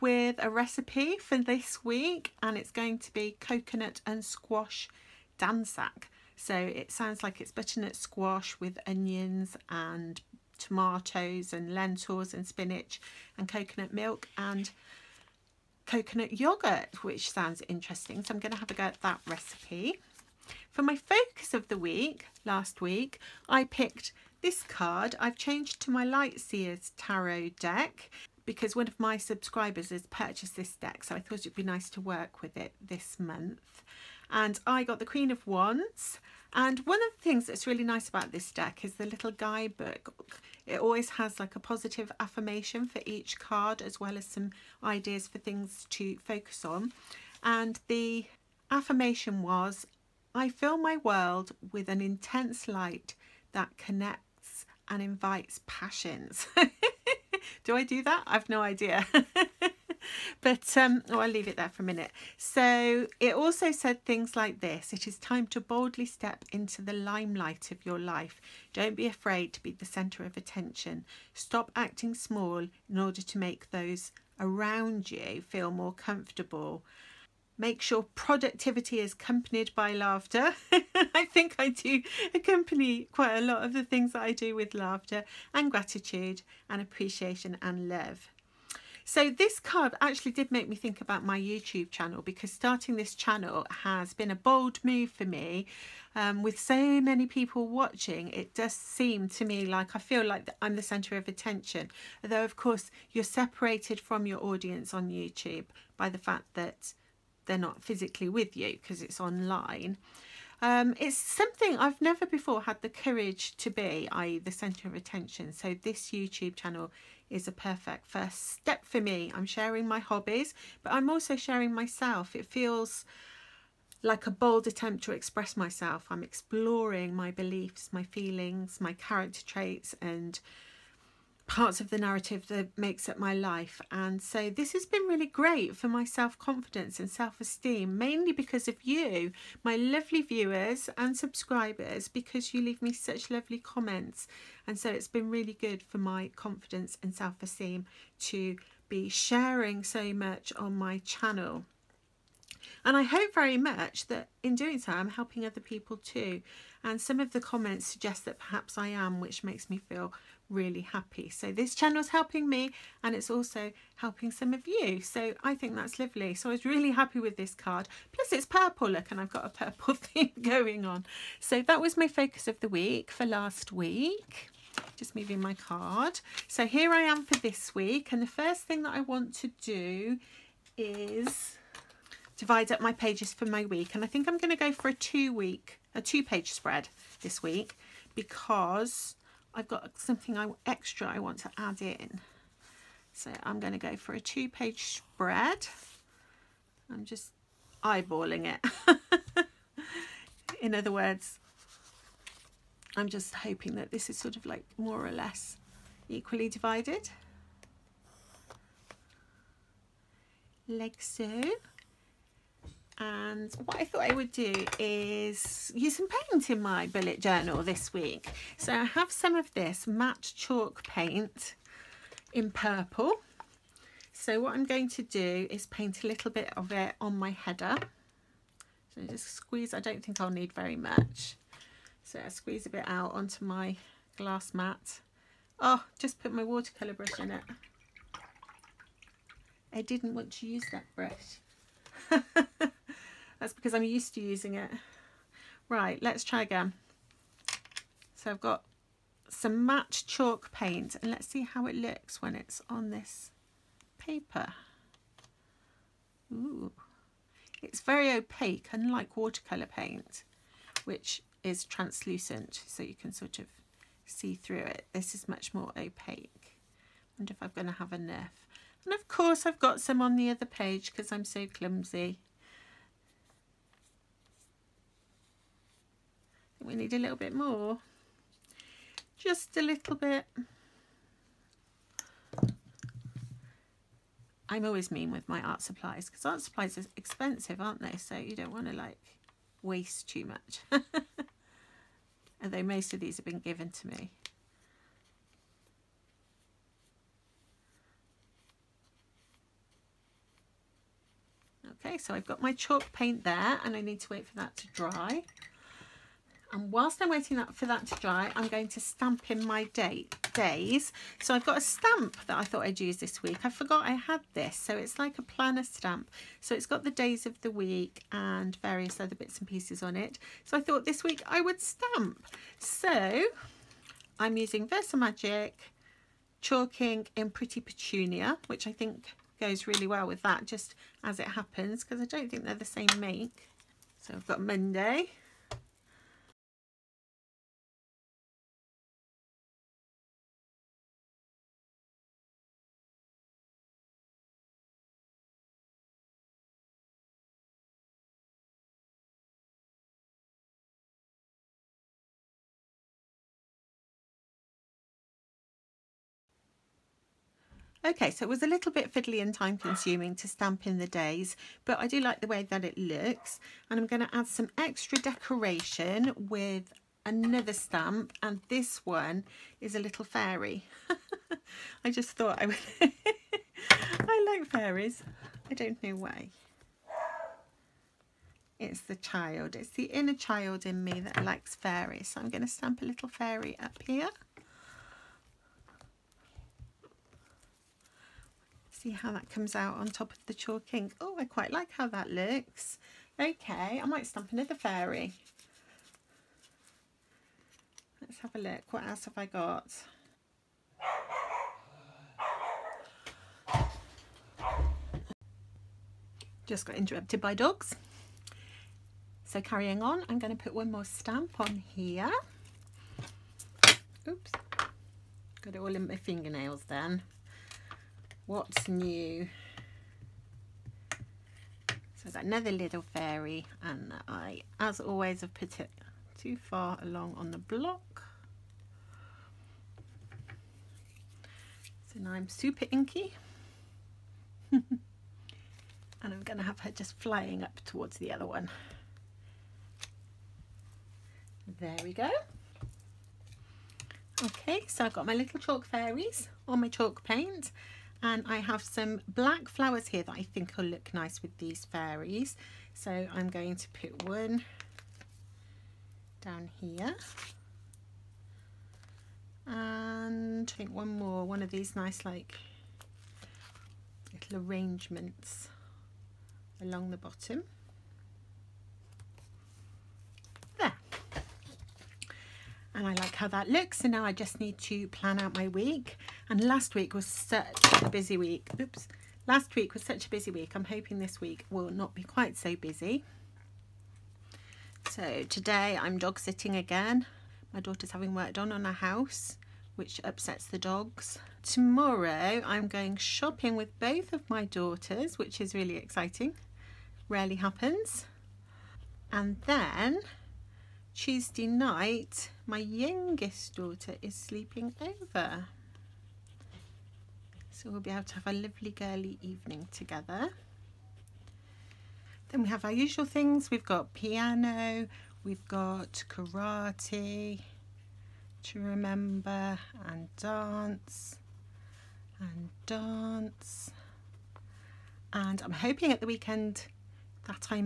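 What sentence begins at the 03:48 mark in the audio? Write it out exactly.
So just squeeze, I don't think I'll need very much.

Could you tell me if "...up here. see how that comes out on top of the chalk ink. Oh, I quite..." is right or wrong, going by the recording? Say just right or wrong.
right.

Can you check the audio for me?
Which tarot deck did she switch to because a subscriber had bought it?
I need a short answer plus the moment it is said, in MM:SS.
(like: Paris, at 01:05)
Light Seer's Tarot, at 00:26.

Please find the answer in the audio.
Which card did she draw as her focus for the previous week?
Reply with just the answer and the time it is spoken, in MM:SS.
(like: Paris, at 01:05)
Queen of Wands, at 00:35.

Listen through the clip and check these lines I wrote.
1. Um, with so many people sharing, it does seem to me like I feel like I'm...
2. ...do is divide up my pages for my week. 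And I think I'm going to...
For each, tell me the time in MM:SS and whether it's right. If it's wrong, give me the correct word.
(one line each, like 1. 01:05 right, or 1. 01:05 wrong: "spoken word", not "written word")
1. 01:36 wrong: "watching", not "sharing"
2. 02:59 right.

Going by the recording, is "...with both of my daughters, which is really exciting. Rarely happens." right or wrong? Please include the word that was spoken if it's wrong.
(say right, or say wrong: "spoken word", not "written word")
right.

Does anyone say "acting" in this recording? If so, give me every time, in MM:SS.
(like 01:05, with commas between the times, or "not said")
01:11.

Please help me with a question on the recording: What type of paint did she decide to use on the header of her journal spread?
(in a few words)
matte chalk paint.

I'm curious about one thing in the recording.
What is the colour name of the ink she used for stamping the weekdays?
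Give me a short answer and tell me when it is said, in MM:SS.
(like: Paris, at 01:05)
Pretty Petunia, at 05:27.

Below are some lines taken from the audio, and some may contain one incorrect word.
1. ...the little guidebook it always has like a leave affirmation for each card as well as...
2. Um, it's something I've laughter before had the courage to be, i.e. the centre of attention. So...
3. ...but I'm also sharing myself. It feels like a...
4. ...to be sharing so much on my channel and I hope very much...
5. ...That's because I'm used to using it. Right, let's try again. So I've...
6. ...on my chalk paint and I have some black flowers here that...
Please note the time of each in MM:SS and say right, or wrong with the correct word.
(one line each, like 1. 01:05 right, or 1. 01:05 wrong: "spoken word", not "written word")
1. 00:38 wrong: "positive", not "leave"
2. 01:50 wrong: "never", not "laughter"
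3. 02:00 right
4. 02:28 right
5. 04:03 right
6. 07:26 right.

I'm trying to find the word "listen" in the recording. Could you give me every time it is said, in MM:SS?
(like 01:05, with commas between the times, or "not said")
not said.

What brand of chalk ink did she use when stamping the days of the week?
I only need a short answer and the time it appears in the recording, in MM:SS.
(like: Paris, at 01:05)
Versamagic, at 05:24.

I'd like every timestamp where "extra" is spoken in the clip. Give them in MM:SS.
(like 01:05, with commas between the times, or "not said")
03:10, 06:04.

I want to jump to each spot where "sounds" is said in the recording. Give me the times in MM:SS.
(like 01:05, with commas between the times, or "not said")
00:06, 00:17.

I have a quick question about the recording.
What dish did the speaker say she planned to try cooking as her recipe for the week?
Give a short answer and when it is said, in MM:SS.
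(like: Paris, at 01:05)
coconut and squash dansak, at 00:03.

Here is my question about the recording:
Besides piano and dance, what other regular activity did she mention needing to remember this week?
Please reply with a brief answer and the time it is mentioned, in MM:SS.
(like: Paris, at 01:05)
karate, at 08:36.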